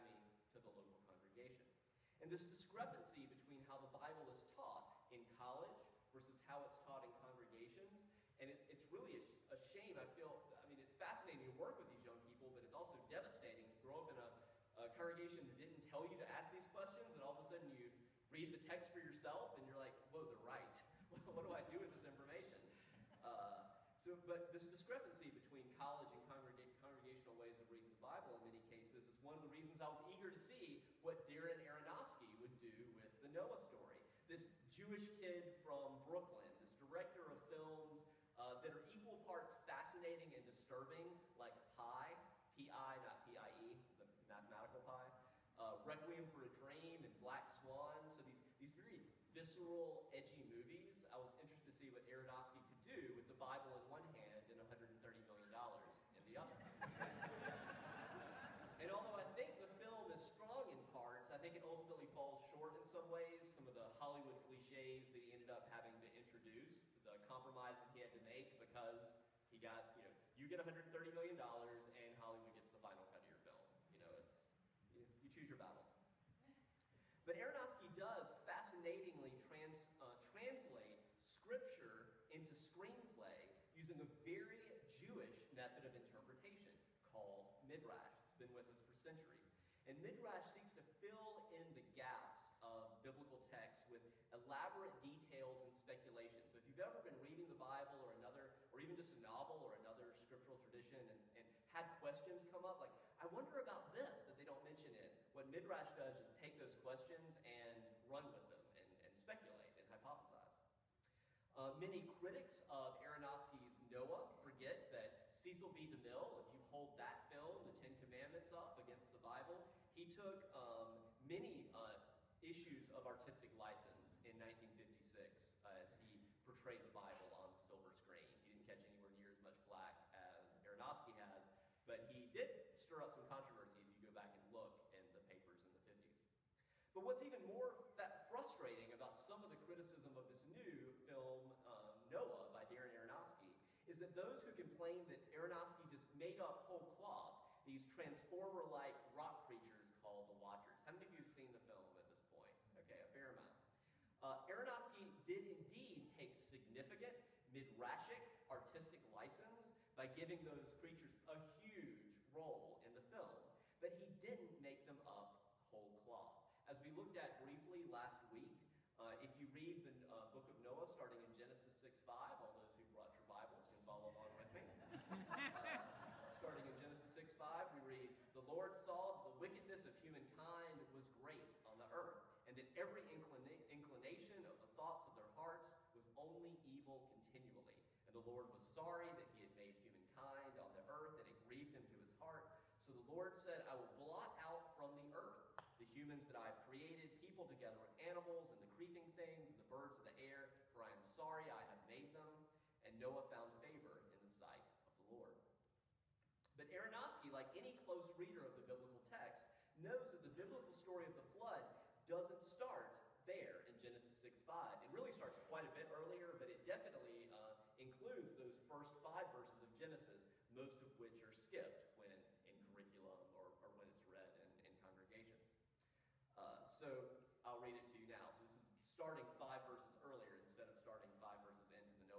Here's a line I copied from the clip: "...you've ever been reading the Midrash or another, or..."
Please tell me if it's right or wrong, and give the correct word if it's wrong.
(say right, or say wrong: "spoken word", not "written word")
wrong: "Bible", not "Midrash".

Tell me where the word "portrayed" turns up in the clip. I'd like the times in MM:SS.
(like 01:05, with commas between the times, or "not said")
02:06.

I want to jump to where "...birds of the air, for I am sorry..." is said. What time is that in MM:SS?
03:19.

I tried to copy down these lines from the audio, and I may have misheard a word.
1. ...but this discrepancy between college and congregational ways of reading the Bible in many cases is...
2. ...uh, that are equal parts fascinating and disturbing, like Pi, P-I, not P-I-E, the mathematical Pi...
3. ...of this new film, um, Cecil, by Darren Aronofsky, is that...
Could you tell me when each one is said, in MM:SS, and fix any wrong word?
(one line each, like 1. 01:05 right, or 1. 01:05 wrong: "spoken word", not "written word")
1. 00:24 right
2. 00:38 right
3. 02:20 wrong: "Noah", not "Cecil".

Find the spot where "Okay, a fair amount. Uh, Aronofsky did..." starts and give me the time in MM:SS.
02:32.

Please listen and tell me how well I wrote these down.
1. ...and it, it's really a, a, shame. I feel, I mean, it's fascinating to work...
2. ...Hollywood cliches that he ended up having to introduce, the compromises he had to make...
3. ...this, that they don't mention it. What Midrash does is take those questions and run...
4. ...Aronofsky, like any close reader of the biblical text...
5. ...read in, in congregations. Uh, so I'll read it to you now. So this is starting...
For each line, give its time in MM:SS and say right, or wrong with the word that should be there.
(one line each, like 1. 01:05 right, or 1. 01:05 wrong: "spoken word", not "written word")
1. 00:08 right
2. 01:03 right
3. 01:43 right
4. 03:26 right
5. 03:44 right.